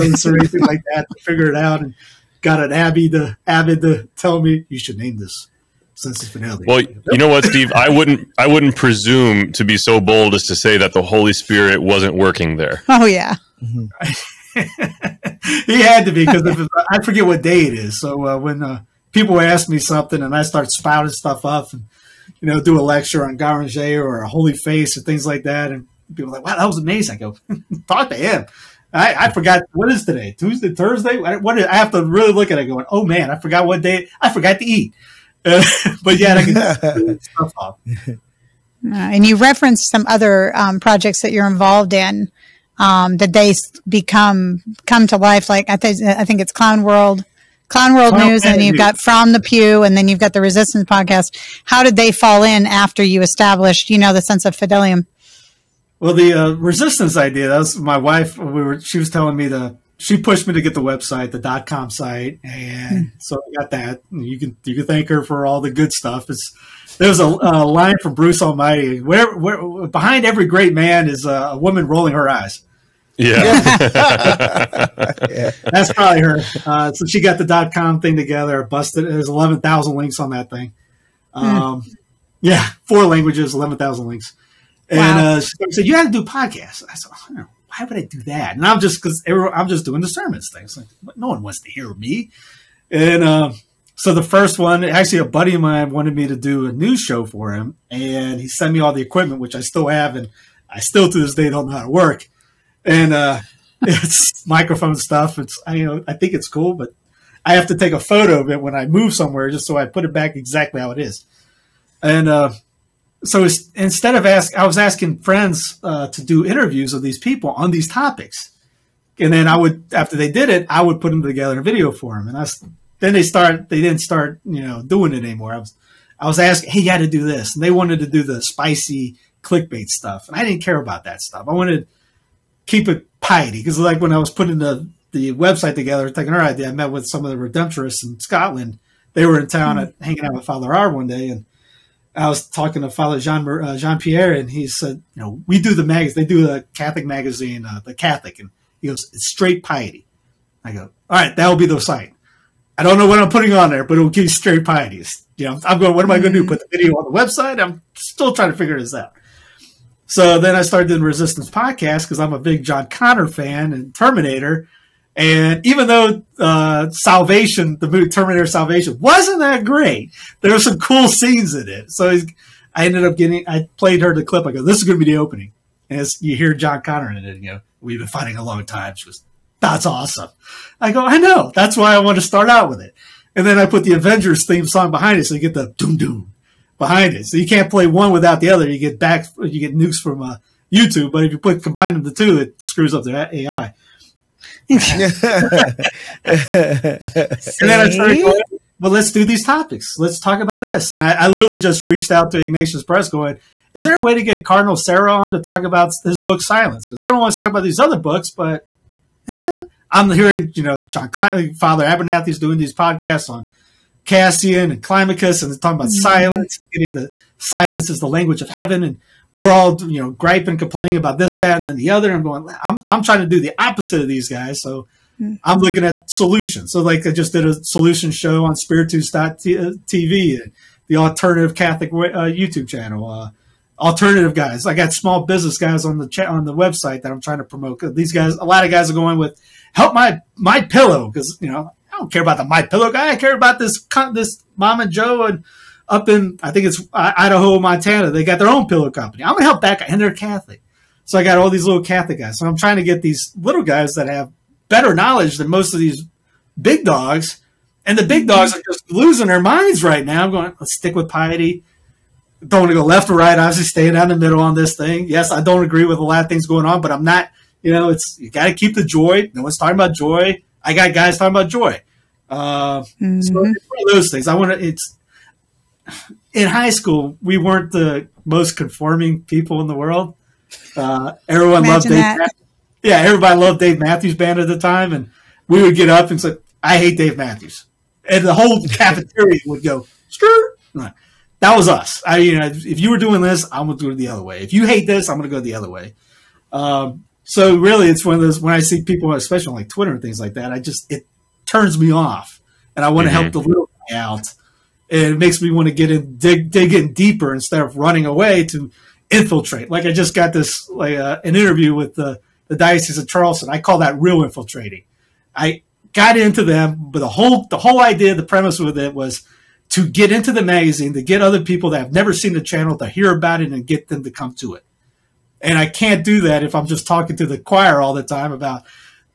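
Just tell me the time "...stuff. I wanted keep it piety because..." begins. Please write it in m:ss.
2:11.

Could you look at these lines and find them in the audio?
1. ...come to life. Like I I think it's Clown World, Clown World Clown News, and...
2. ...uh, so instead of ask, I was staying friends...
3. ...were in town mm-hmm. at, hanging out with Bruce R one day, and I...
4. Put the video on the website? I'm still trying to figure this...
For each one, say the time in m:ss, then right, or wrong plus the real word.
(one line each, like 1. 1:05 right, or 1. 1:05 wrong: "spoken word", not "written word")
1. 0:44 right
2. 1:52 wrong: "asking", not "staying"
3. 2:19 wrong: "Father", not "Bruce"
4. 2:36 right.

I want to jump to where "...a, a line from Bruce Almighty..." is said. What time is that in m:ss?
1:07.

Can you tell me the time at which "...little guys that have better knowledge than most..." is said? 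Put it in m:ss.
4:13.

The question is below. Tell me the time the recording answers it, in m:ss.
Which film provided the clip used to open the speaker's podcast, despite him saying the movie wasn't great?
2:48.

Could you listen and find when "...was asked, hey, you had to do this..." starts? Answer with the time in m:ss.
2:06.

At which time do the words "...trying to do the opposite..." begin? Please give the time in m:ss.
3:43.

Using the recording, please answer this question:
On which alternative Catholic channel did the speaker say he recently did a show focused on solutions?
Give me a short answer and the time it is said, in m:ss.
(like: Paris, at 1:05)
Spiritus.tv, at 3:48.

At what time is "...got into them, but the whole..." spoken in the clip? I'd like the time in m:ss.
5:15.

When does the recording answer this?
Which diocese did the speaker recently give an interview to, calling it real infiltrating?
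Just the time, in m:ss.
5:12.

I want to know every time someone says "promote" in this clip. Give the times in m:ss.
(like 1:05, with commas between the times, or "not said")
3:57.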